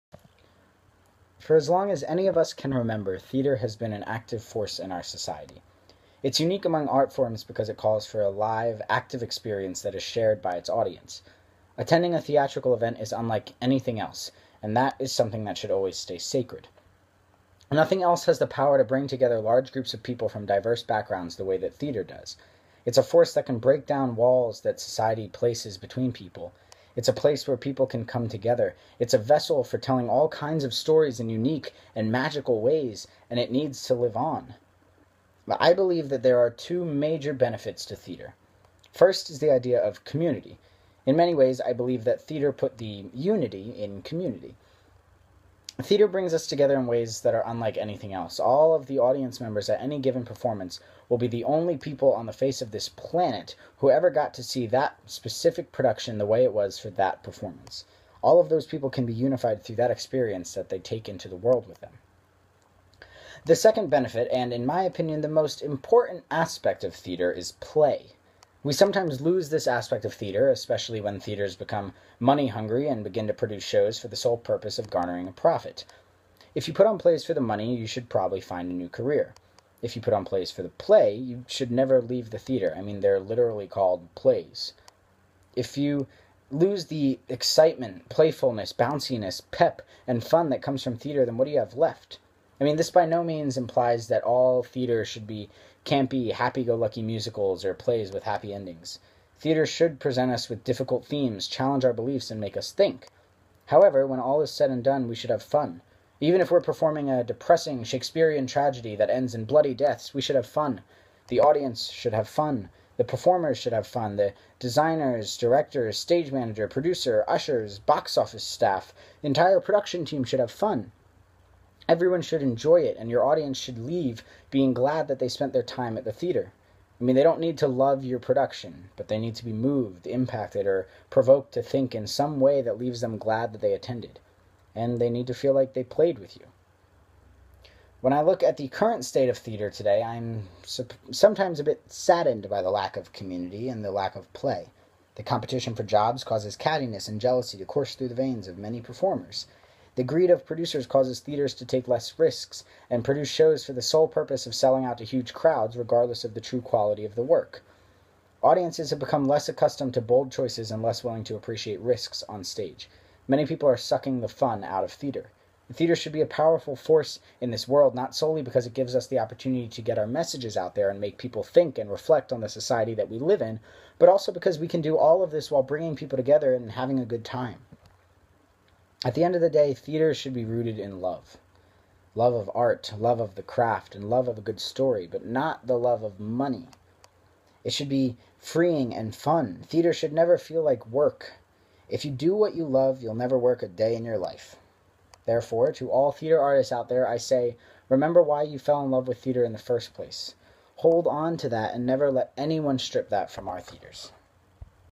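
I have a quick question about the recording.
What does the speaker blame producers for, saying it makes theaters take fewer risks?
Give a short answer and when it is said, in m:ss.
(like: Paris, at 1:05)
greed, at 2:30.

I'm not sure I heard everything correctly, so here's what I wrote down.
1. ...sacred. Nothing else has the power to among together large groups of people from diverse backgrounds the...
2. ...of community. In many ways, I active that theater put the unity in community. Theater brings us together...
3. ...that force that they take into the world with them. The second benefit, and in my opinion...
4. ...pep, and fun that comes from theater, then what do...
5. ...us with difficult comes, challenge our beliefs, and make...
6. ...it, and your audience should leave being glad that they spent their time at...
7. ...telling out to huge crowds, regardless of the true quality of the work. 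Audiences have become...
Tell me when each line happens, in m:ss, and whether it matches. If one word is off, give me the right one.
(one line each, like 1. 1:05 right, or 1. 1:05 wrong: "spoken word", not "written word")
1. 0:16 wrong: "bring", not "among"
2. 0:39 wrong: "believe", not "active"
3. 0:59 wrong: "experience", not "force"
4. 1:29 right
5. 1:40 wrong: "themes", not "comes"
6. 2:02 right
7. 2:34 wrong: "selling", not "telling".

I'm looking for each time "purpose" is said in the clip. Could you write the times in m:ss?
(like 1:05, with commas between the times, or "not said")
1:14, 2:34.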